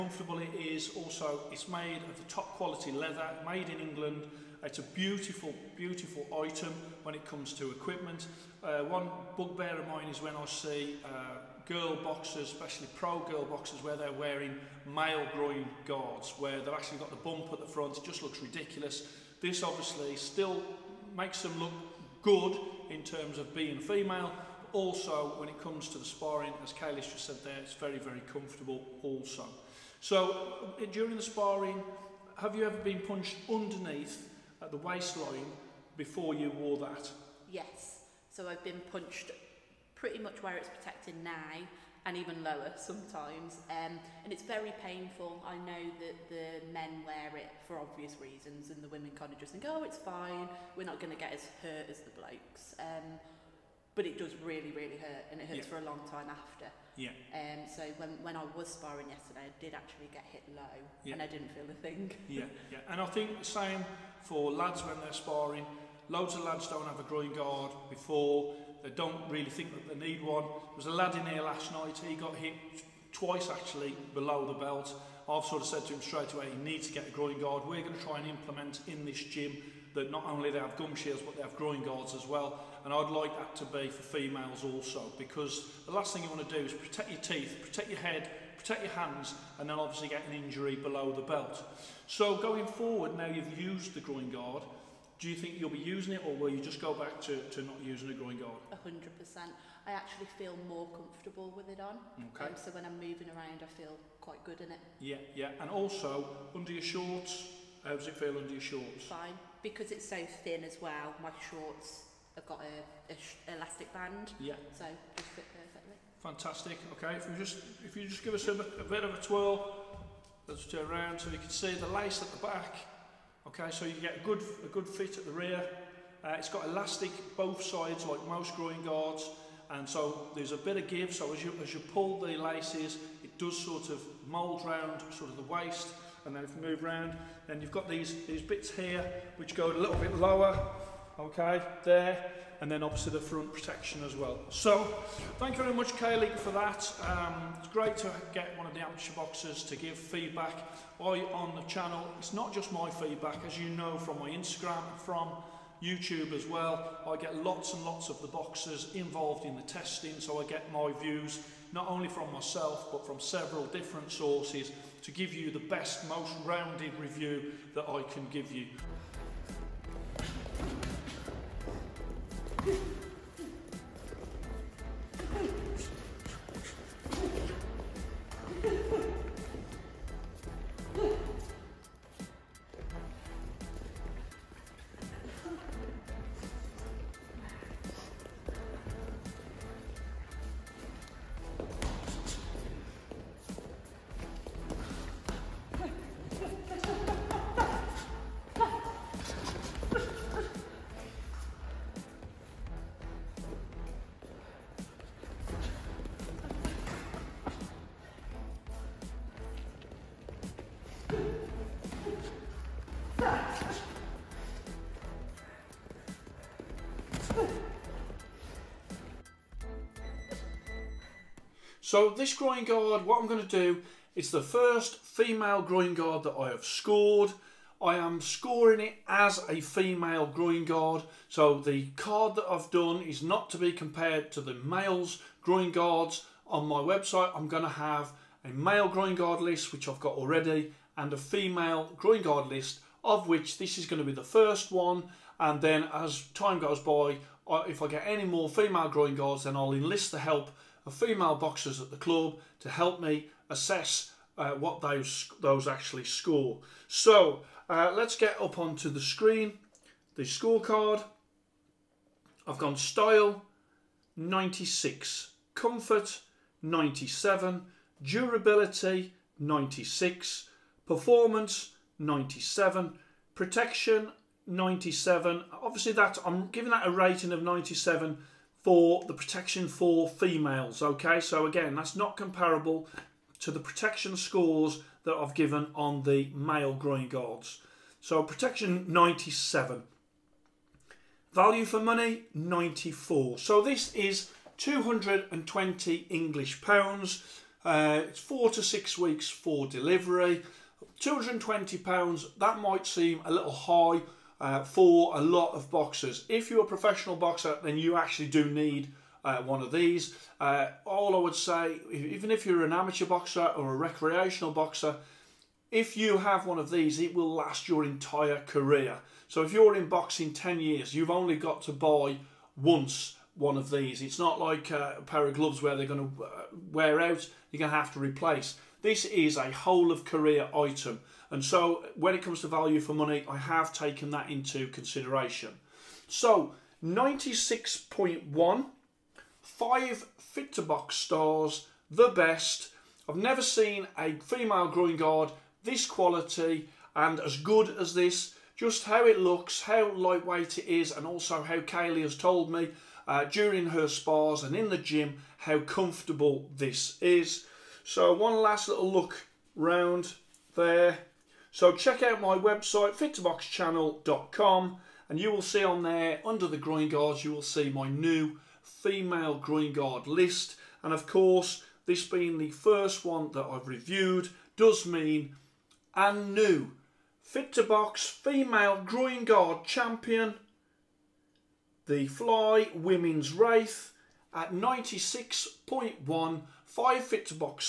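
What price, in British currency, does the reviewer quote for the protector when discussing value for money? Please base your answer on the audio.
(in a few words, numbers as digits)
220 pounds.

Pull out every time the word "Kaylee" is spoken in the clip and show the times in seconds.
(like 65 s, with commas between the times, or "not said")
145 s, 351 s.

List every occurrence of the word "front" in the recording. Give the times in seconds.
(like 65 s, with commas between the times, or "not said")
17 s, 143 s.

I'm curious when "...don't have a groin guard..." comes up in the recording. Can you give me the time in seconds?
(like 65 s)
66 s.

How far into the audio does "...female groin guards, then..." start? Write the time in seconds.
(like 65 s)
248 s.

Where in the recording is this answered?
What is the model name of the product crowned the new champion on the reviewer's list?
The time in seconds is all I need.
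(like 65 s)
382 s.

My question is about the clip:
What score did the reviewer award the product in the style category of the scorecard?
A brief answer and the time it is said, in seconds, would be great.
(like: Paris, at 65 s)
96, at 262 s.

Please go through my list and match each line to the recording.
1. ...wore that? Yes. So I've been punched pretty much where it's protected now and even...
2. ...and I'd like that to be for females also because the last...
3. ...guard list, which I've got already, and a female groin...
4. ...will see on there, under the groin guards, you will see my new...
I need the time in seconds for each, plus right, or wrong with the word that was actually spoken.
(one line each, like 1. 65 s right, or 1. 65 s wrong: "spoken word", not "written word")
1. 36 s right
2. 82 s right
3. 239 s right
4. 365 s right.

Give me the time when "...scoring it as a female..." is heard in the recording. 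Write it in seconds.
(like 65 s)
228 s.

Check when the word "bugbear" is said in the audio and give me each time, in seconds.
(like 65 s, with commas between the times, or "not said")
9 s.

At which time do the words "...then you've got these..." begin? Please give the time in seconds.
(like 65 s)
137 s.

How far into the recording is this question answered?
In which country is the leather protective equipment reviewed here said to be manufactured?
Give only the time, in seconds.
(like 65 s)
3 s.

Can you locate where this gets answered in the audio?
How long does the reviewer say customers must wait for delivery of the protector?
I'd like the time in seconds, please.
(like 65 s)
298 s.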